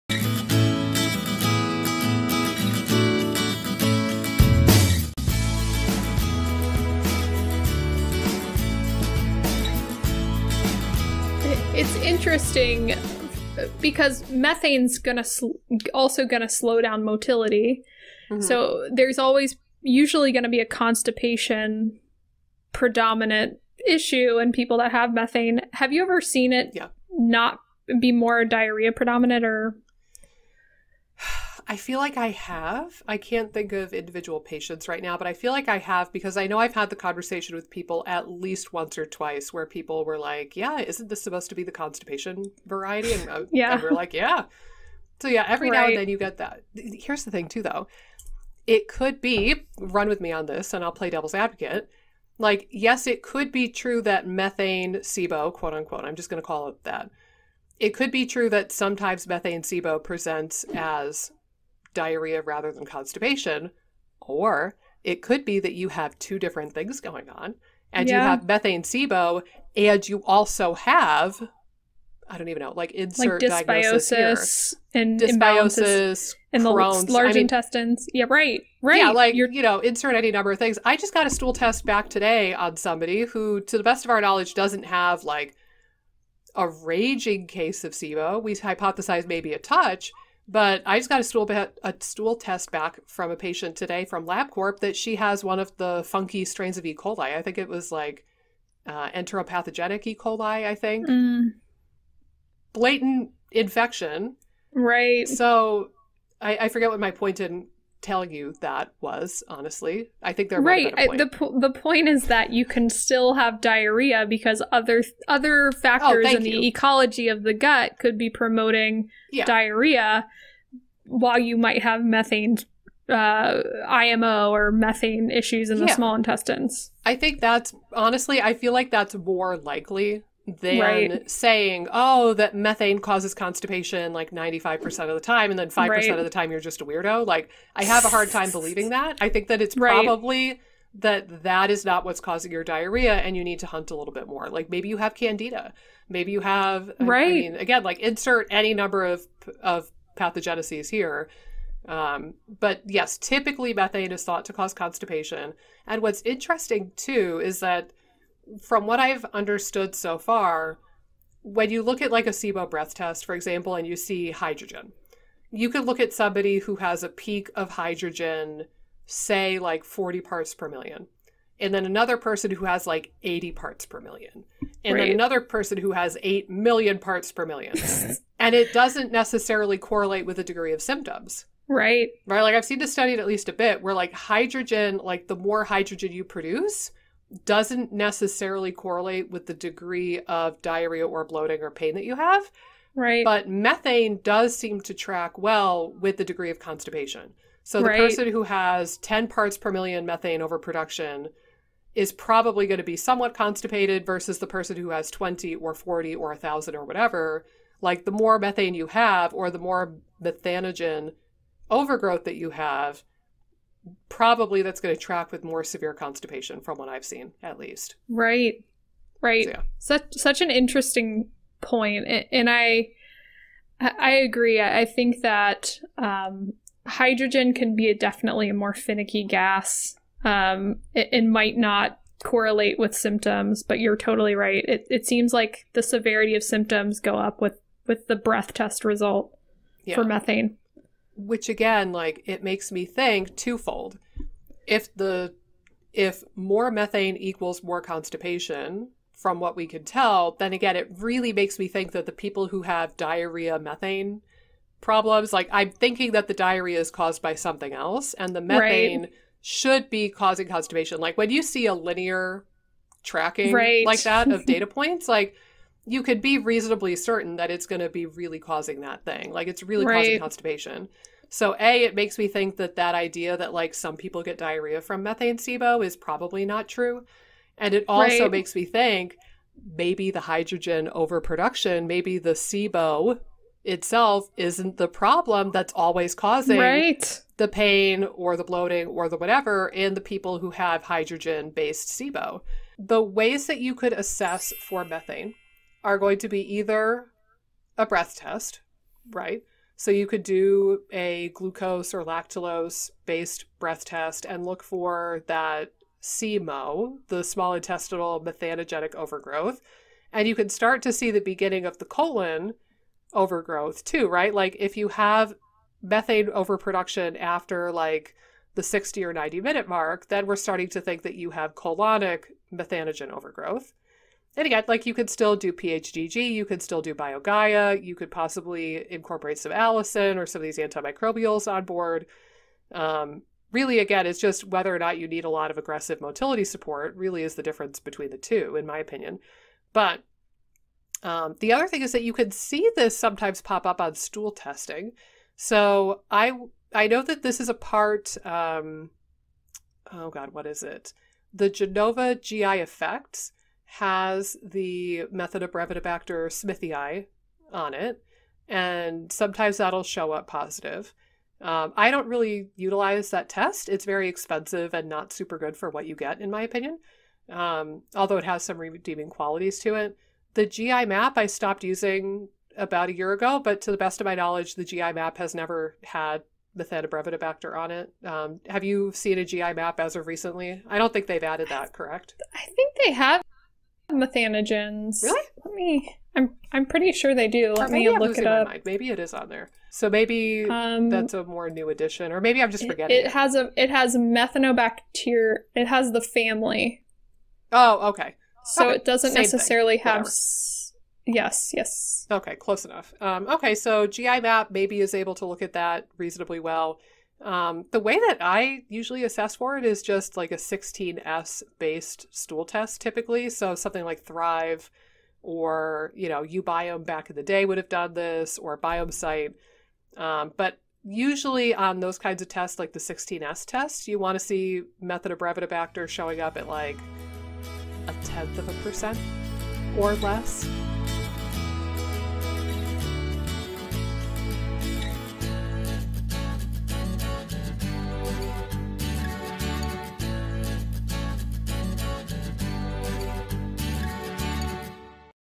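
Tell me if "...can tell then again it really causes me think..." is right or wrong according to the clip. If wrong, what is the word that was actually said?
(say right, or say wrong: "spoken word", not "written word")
wrong: "makes", not "causes".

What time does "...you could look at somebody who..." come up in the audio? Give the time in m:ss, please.
2:45.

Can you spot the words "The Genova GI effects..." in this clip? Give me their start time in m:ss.
5:51.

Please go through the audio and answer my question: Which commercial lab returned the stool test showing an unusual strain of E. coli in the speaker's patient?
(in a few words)
LabCorp.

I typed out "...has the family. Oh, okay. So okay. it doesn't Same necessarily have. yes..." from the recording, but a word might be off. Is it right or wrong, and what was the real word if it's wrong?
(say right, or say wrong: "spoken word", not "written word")
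right.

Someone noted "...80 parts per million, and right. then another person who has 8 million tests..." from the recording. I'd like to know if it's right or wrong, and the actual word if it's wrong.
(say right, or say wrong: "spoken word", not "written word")
wrong: "parts", not "tests".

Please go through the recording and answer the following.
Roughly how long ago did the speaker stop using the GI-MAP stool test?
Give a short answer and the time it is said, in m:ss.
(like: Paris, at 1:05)
about a year ago, at 6:12.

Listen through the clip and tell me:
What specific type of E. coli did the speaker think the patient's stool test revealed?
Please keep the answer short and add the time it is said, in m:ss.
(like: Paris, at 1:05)
enteropathogenic E. coli, at 1:39.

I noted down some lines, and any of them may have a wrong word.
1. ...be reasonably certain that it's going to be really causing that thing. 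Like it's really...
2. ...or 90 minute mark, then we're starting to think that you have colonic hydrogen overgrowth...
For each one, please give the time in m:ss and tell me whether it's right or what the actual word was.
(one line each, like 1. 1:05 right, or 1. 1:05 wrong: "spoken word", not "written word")
1. 4:26 right
2. 5:19 wrong: "methanogen", not "hydrogen".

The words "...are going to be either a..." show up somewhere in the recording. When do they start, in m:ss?
4:55.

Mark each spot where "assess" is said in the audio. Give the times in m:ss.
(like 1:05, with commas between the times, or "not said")
4:53, 6:49.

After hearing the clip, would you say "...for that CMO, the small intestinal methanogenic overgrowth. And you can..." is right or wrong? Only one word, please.
right.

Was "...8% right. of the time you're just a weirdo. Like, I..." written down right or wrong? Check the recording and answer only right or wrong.
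wrong.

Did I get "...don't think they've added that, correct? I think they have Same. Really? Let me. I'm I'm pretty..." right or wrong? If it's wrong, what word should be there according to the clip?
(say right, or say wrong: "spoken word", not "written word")
wrong: "Methanogens", not "Same".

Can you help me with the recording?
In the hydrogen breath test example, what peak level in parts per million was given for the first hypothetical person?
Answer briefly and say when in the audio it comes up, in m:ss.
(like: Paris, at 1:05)
40, at 2:49.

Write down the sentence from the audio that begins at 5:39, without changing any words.
But um, the other thing is that you can see this sometimes pop up on stool testing.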